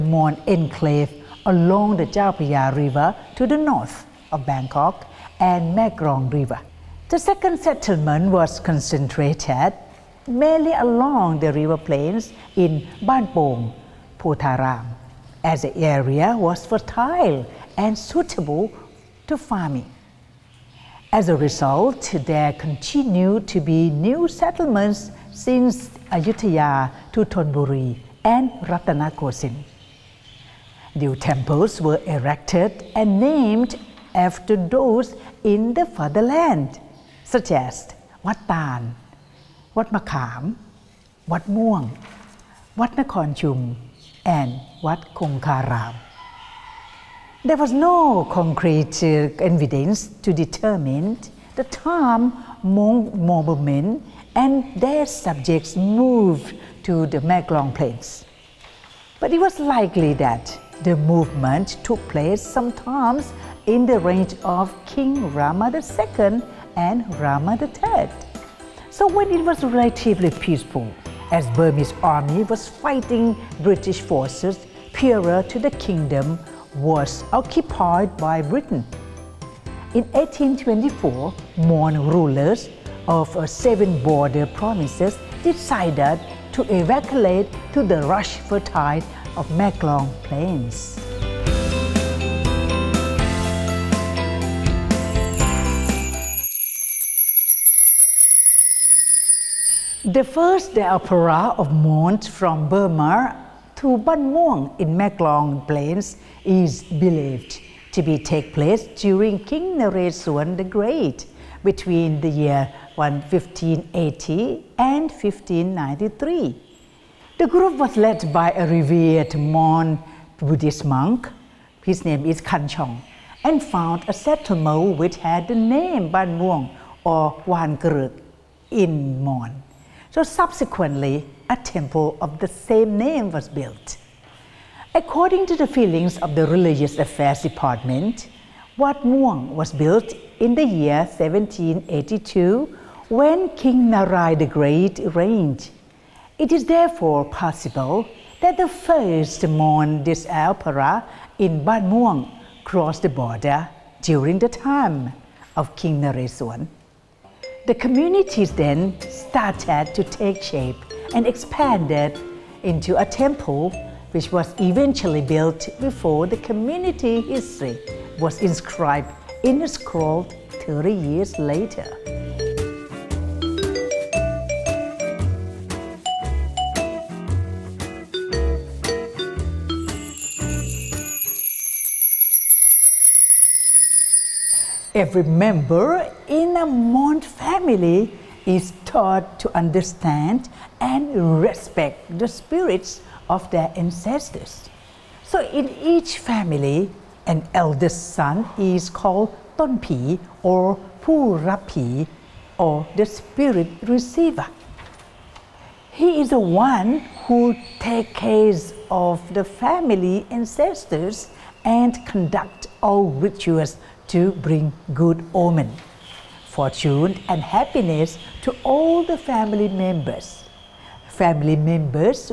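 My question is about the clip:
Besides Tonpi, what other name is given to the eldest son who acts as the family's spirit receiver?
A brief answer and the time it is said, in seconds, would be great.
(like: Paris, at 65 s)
Purapi, at 201 s.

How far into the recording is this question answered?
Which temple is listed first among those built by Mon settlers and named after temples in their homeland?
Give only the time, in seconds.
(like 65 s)
38 s.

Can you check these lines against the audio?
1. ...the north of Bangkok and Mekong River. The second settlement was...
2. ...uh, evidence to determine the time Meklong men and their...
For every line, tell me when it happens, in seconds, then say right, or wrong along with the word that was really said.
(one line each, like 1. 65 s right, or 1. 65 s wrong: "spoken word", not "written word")
1. 3 s right
2. 49 s wrong: "Mon", not "Meklong".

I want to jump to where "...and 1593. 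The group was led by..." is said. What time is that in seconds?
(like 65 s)
114 s.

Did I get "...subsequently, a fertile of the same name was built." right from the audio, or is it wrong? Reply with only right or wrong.
wrong.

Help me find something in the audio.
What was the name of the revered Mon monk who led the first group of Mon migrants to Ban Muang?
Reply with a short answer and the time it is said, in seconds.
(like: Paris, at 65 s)
Kanchong, at 122 s.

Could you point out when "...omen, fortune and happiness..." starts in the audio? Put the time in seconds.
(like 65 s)
215 s.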